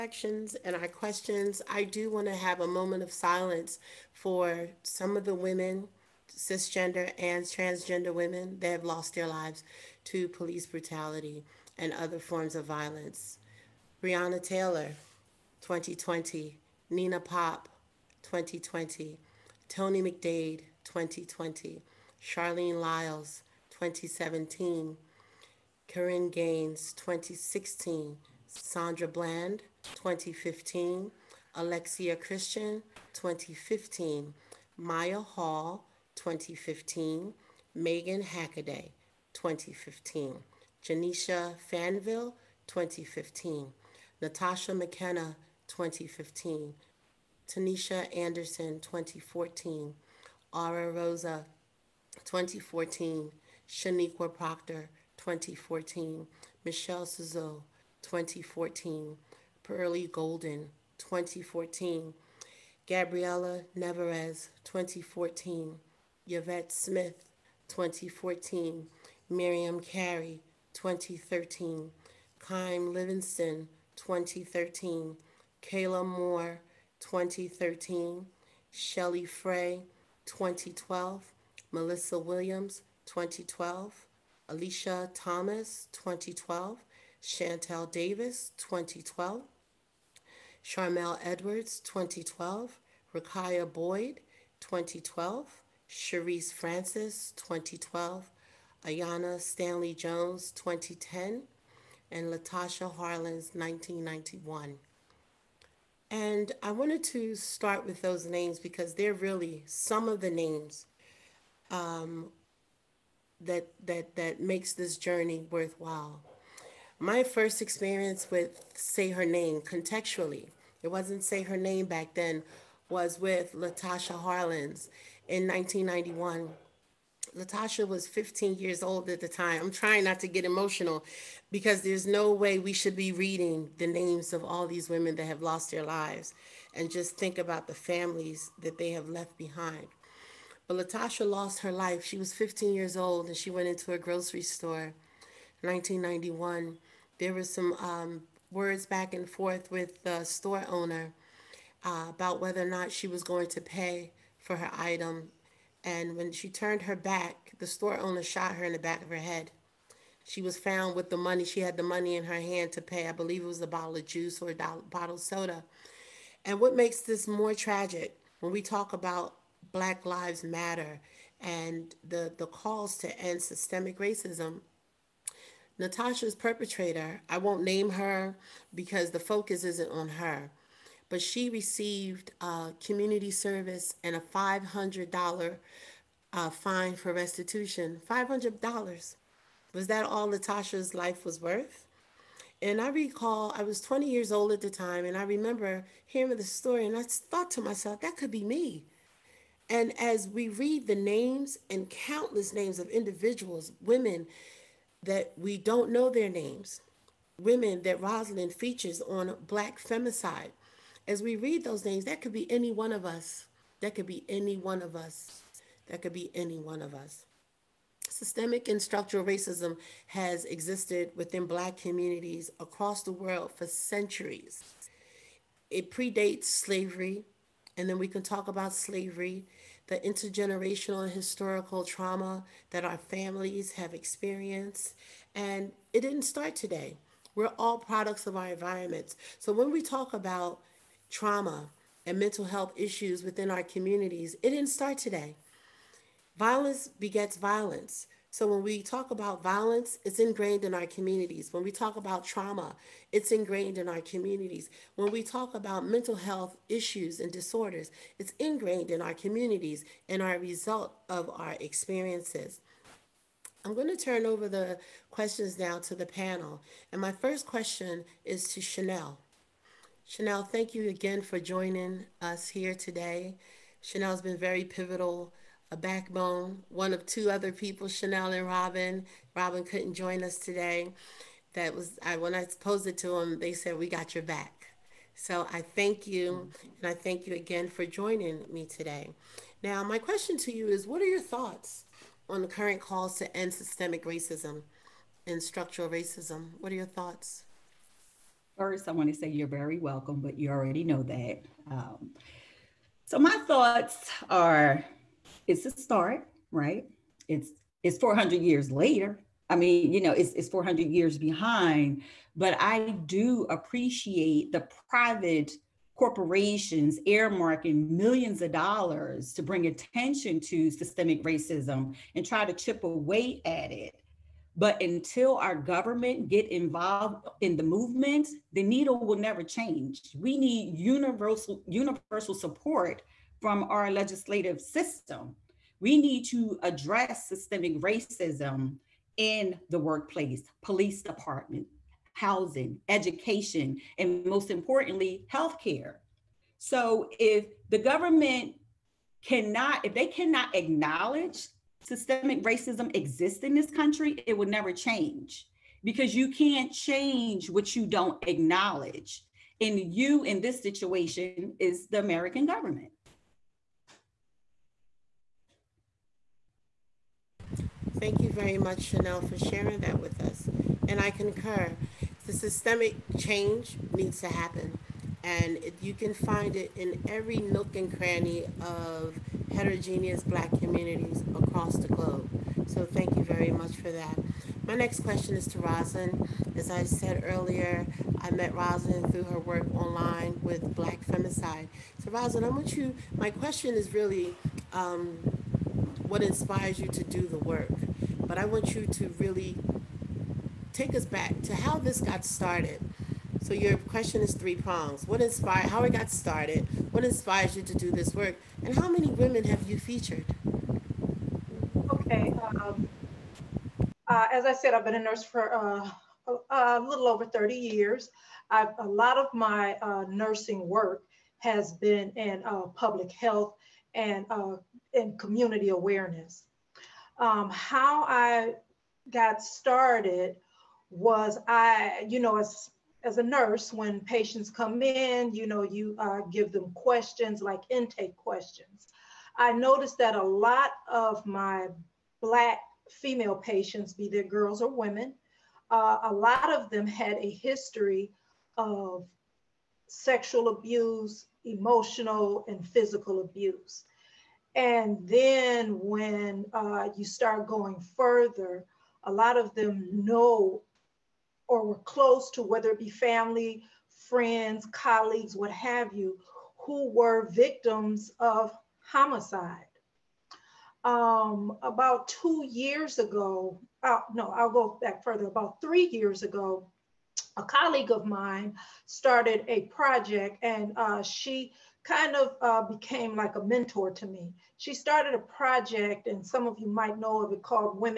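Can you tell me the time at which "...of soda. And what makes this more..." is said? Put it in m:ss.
2:45.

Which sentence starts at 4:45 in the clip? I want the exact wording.
So I thank you and I thank you again for joining me today.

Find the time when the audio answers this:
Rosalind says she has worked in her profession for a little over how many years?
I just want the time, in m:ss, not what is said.
6:57.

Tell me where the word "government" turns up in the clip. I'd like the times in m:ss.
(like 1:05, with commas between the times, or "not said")
5:25, 5:47, 6:02.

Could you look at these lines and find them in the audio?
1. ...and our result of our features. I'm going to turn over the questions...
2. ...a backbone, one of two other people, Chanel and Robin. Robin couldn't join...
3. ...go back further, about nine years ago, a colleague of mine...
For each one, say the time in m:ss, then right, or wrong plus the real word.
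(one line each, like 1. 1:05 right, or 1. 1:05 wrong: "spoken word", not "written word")
1. 4:20 wrong: "experiences", not "features"
2. 4:35 right
3. 7:54 wrong: "three", not "nine".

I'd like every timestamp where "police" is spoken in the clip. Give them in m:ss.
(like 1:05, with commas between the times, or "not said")
0:10, 5:40.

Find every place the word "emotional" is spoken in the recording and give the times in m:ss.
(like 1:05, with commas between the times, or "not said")
2:10, 7:31.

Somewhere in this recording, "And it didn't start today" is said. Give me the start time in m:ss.
3:55.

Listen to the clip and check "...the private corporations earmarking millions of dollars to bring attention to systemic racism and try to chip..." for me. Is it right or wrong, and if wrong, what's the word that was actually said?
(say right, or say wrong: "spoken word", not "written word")
right.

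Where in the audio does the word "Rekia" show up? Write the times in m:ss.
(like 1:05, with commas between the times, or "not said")
1:33.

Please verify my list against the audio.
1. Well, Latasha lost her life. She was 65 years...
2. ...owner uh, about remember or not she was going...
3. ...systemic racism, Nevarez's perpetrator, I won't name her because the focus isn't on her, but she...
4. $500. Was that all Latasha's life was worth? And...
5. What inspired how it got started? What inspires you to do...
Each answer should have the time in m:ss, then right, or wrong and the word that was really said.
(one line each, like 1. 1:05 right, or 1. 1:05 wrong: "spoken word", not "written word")
1. 2:20 wrong: "15", not "65"
2. 2:30 wrong: "whether", not "remember"
3. 2:53 wrong: "Latasha", not "Nevarez"
4. 3:08 right
5. 6:45 right.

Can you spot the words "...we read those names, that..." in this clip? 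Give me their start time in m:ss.
3:31.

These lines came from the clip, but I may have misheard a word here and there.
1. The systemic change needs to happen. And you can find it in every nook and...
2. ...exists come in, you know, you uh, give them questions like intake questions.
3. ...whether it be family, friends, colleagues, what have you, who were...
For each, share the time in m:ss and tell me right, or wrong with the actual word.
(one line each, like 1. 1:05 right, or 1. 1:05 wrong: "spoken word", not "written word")
1. 6:12 right
2. 7:14 wrong: "patients", not "exists"
3. 7:42 right.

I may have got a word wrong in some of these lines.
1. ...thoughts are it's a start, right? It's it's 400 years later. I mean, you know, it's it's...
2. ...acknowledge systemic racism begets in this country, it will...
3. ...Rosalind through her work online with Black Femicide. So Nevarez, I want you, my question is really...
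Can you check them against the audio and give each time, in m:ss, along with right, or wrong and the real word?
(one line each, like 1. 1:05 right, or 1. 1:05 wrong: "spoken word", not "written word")
1. 5:03 right
2. 5:50 wrong: "exists", not "begets"
3. 6:28 wrong: "Rosalind", not "Nevarez".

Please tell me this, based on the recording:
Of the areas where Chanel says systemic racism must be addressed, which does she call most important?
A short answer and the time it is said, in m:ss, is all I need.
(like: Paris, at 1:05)
healthcare, at 5:45.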